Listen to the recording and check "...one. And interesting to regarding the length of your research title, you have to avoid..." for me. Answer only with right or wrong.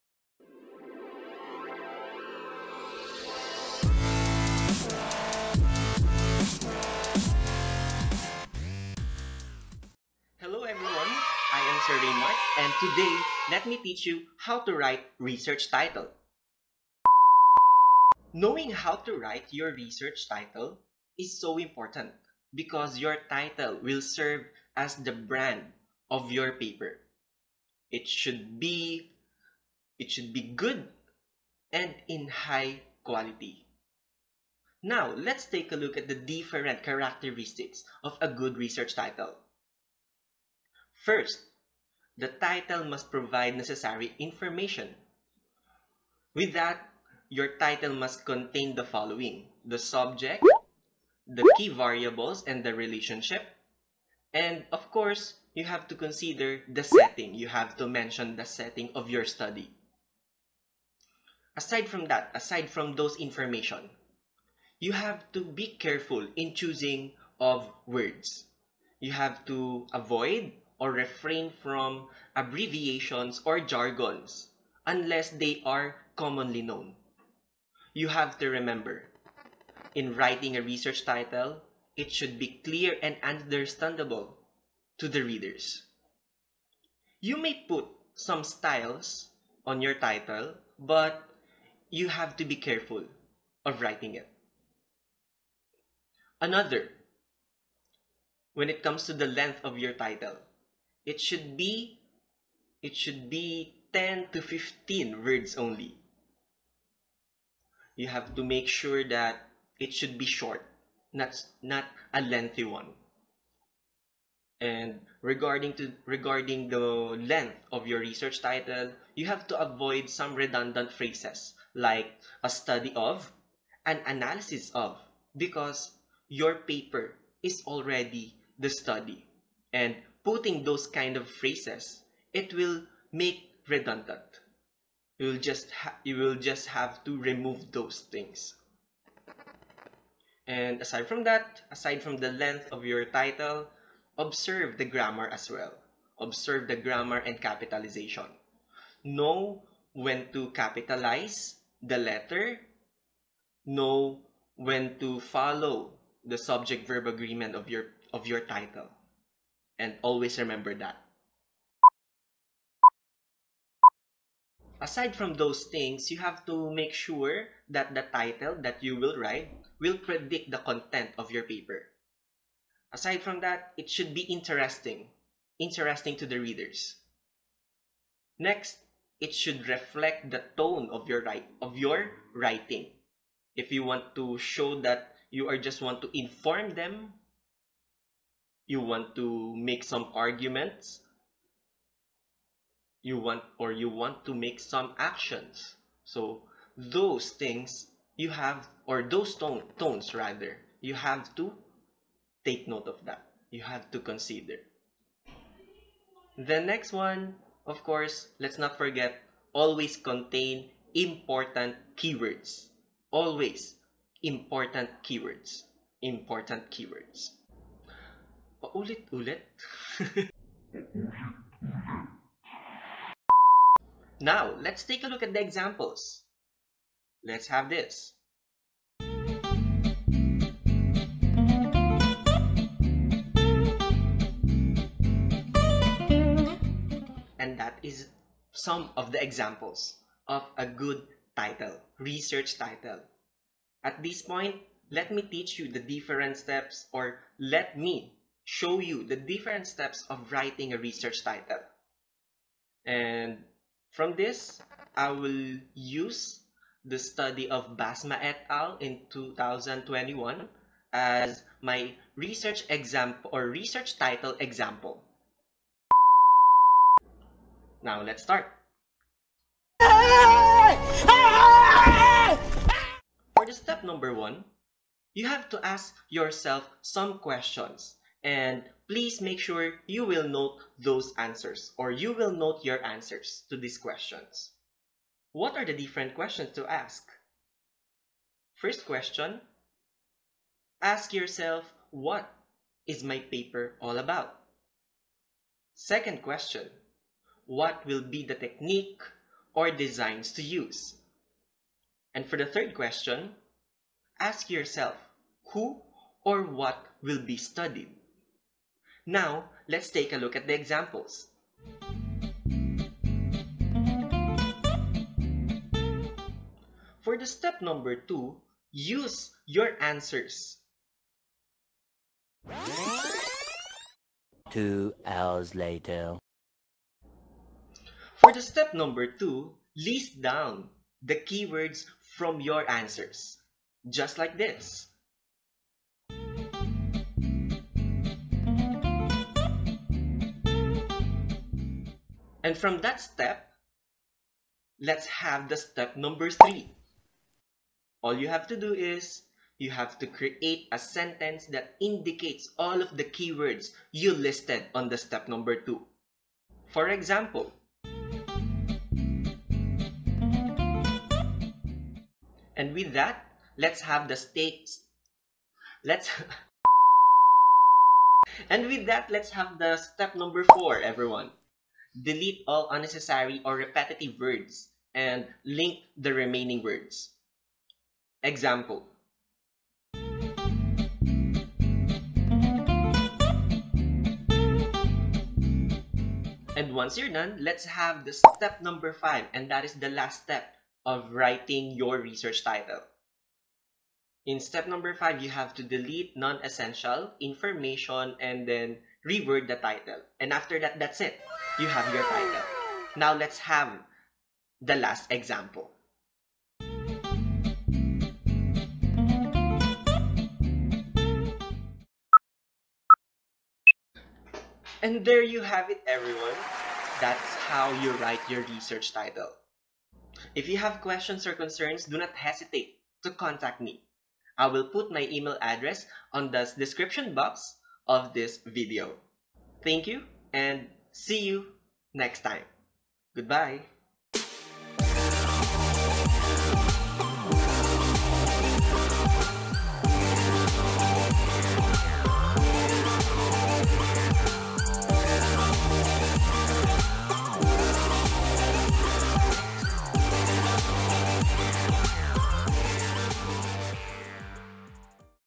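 wrong.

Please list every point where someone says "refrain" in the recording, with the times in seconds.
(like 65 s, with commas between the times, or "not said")
70 s.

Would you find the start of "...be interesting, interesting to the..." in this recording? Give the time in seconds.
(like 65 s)
174 s.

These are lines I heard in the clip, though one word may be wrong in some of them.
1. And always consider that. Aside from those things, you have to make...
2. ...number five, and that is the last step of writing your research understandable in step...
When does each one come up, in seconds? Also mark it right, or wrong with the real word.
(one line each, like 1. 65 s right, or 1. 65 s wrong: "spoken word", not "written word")
1. 159 s wrong: "remember", not "consider"
2. 388 s wrong: "title", not "understandable".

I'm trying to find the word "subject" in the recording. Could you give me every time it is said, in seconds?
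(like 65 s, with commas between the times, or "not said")
49 s, 156 s.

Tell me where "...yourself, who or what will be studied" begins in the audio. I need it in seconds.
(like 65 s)
304 s.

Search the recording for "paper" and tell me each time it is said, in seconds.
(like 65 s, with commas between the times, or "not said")
26 s, 126 s, 171 s, 293 s.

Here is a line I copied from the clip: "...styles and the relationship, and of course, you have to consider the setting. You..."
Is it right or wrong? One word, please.
wrong.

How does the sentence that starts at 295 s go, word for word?
Second question, what will be the technique or designs to use?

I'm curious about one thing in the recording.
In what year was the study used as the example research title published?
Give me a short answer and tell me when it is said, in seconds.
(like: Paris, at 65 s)
2021, at 259 s.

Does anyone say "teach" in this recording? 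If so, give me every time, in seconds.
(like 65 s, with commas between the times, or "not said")
13 s, 245 s.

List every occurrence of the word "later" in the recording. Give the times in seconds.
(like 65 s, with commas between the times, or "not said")
325 s.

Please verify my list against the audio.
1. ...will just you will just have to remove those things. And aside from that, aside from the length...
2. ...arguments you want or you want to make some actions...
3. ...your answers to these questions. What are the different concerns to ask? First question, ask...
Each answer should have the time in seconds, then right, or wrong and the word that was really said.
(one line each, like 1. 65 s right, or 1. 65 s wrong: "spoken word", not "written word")
1. 135 s right
2. 190 s right
3. 282 s wrong: "questions", not "concerns".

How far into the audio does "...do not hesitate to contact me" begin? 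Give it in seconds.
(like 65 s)
421 s.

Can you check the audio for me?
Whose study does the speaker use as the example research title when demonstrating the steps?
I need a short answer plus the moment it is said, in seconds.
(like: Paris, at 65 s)
Basma et al., at 257 s.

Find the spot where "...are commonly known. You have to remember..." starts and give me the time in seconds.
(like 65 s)
75 s.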